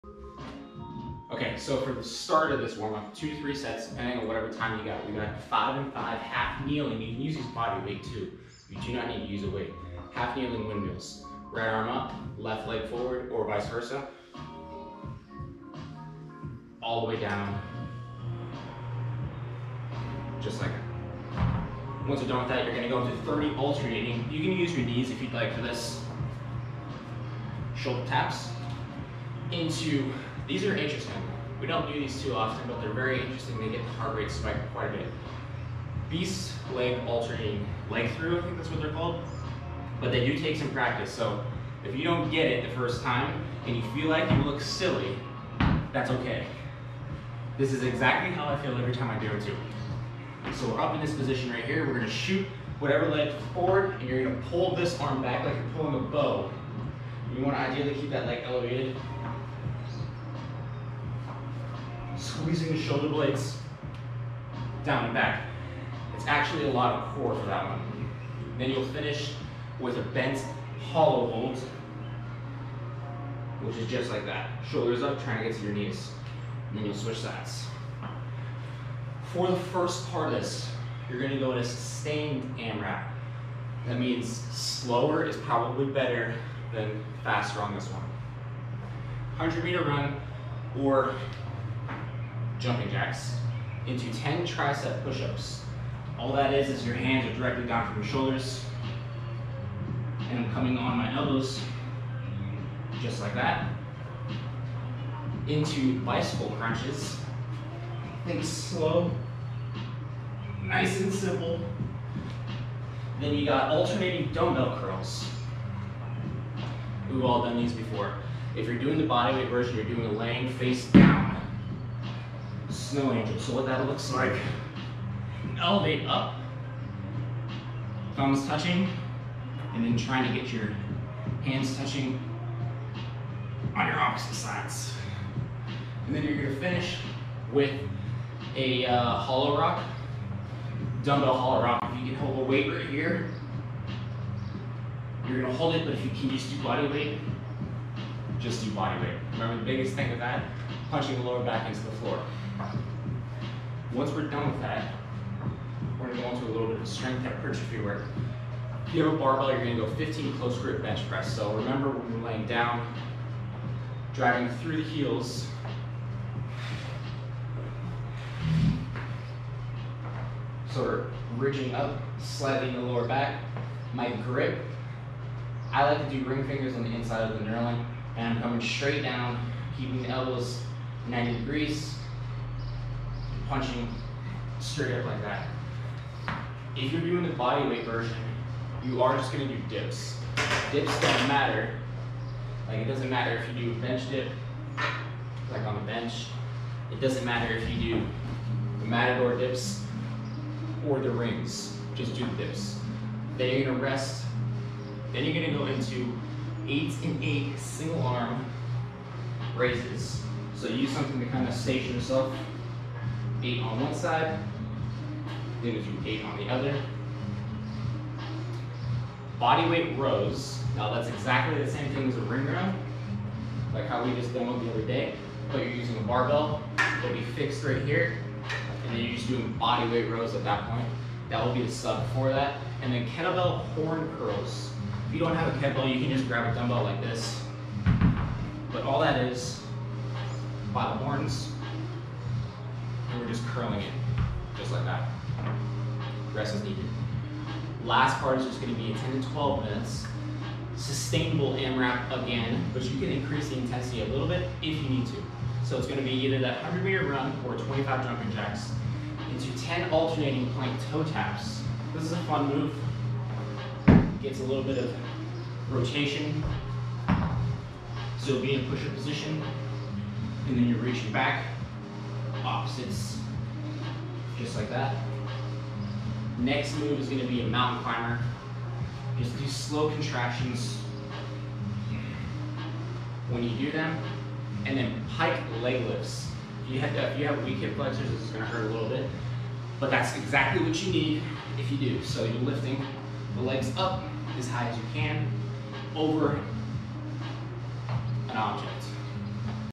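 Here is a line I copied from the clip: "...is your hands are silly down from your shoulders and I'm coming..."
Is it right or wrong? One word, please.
wrong.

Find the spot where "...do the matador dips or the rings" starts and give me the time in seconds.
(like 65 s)
197 s.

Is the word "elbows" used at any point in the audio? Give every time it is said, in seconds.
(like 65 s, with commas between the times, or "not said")
101 s, 180 s.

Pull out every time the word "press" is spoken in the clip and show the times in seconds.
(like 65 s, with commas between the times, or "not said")
161 s.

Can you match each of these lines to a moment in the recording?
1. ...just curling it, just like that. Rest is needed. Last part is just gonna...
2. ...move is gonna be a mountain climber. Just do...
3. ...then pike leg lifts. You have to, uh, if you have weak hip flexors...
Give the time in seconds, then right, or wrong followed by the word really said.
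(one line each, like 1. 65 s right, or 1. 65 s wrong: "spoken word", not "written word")
1. 243 s right
2. 276 s right
3. 284 s right.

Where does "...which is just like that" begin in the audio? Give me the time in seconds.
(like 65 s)
73 s.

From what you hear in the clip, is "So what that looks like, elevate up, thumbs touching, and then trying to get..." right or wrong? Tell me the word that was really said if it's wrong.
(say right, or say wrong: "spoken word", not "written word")
right.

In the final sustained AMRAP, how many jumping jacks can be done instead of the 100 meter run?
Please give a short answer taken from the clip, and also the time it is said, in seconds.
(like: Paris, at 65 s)
25, at 257 s.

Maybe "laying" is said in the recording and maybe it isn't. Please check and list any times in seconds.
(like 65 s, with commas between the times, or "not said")
120 s, 162 s.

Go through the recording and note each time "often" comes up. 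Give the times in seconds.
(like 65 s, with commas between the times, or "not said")
32 s.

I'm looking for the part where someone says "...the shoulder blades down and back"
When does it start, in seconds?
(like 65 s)
62 s.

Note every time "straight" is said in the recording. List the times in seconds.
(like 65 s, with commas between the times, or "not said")
178 s, 184 s.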